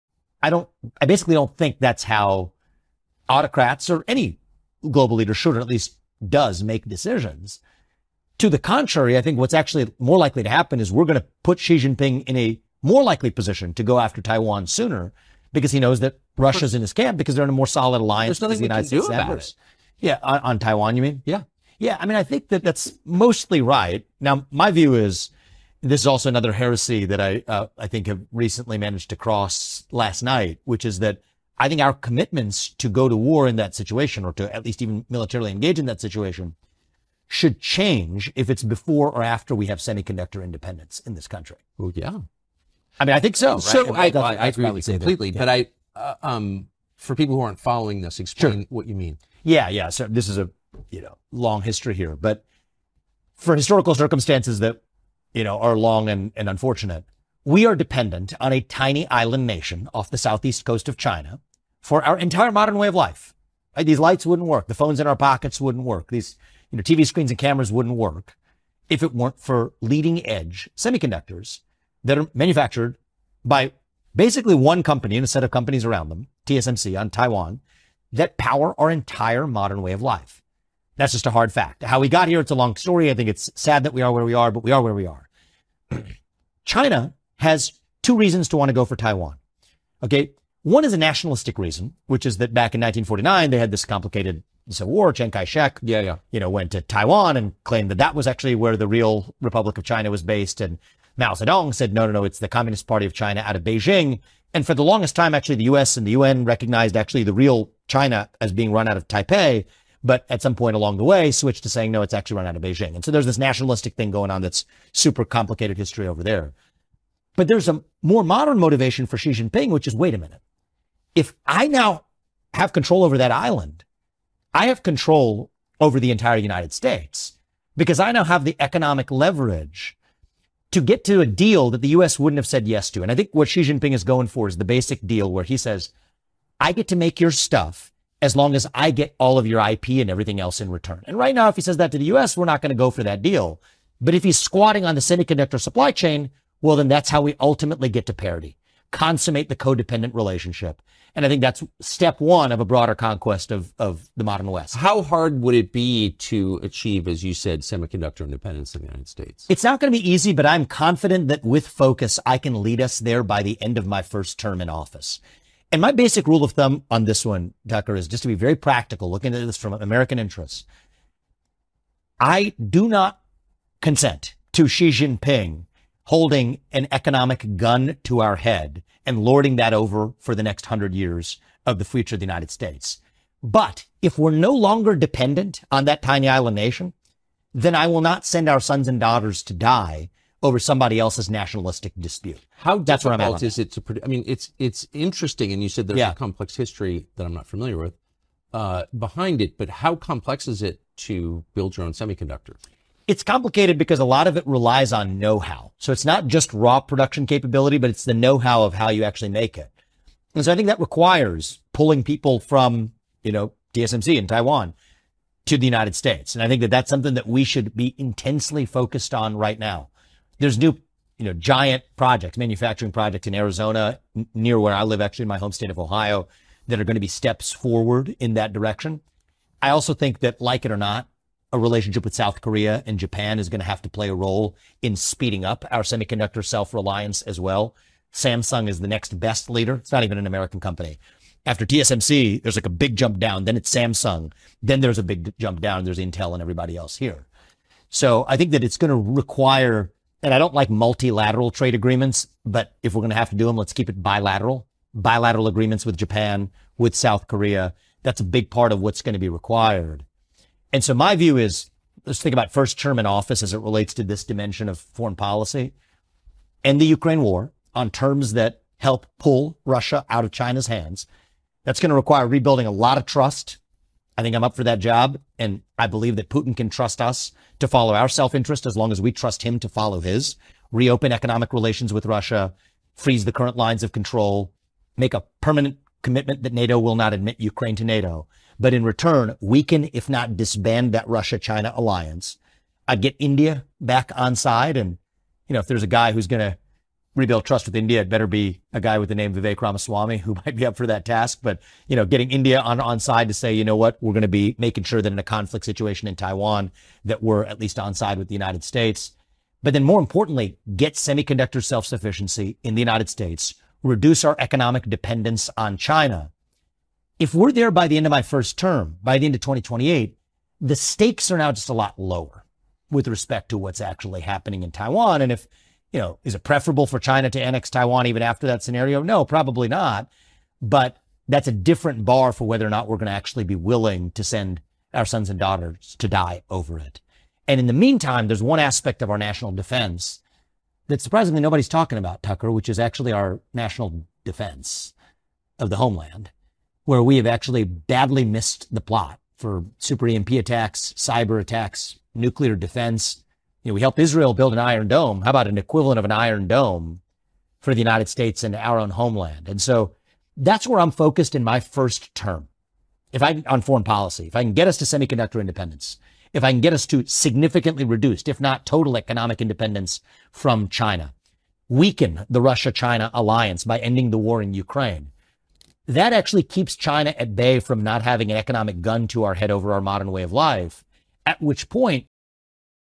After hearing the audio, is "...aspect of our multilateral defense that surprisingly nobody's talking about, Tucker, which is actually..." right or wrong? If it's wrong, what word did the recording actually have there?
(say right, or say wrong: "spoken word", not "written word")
wrong: "national", not "multilateral".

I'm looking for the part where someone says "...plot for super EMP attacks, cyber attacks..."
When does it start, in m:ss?
5:48.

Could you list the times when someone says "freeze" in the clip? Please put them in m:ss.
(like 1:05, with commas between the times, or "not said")
4:42.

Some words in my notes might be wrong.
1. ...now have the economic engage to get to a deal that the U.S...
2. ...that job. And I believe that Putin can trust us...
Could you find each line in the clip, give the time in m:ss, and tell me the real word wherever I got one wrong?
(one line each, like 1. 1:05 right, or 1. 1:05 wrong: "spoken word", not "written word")
1. 2:08 wrong: "leverage", not "engage"
2. 4:34 right.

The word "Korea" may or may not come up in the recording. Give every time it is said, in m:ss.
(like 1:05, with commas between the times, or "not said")
3:52, 4:17.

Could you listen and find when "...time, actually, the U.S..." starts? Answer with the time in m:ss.
1:45.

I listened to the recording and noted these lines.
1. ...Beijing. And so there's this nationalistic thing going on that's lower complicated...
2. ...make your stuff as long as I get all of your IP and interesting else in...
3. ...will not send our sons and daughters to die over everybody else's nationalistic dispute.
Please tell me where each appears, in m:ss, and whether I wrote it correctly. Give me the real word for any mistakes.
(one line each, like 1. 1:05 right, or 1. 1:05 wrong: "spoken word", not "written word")
1. 1:52 wrong: "super", not "lower"
2. 2:16 wrong: "everything", not "interesting"
3. 3:07 wrong: "somebody", not "everybody".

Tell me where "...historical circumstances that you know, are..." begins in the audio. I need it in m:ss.
0:53.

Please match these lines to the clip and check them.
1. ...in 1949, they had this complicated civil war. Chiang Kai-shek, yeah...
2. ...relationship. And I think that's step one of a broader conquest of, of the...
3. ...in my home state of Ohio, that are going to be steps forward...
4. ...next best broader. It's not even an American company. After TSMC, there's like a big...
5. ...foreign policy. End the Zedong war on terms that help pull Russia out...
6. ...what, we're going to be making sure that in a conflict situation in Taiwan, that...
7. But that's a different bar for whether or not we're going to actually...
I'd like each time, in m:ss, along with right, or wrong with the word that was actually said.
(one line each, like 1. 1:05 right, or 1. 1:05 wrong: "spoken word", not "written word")
1. 1:32 right
2. 2:30 right
3. 3:45 right
4. 3:58 wrong: "leader", not "broader"
5. 4:24 wrong: "Ukraine", not "Zedong"
6. 5:03 right
7. 5:30 right.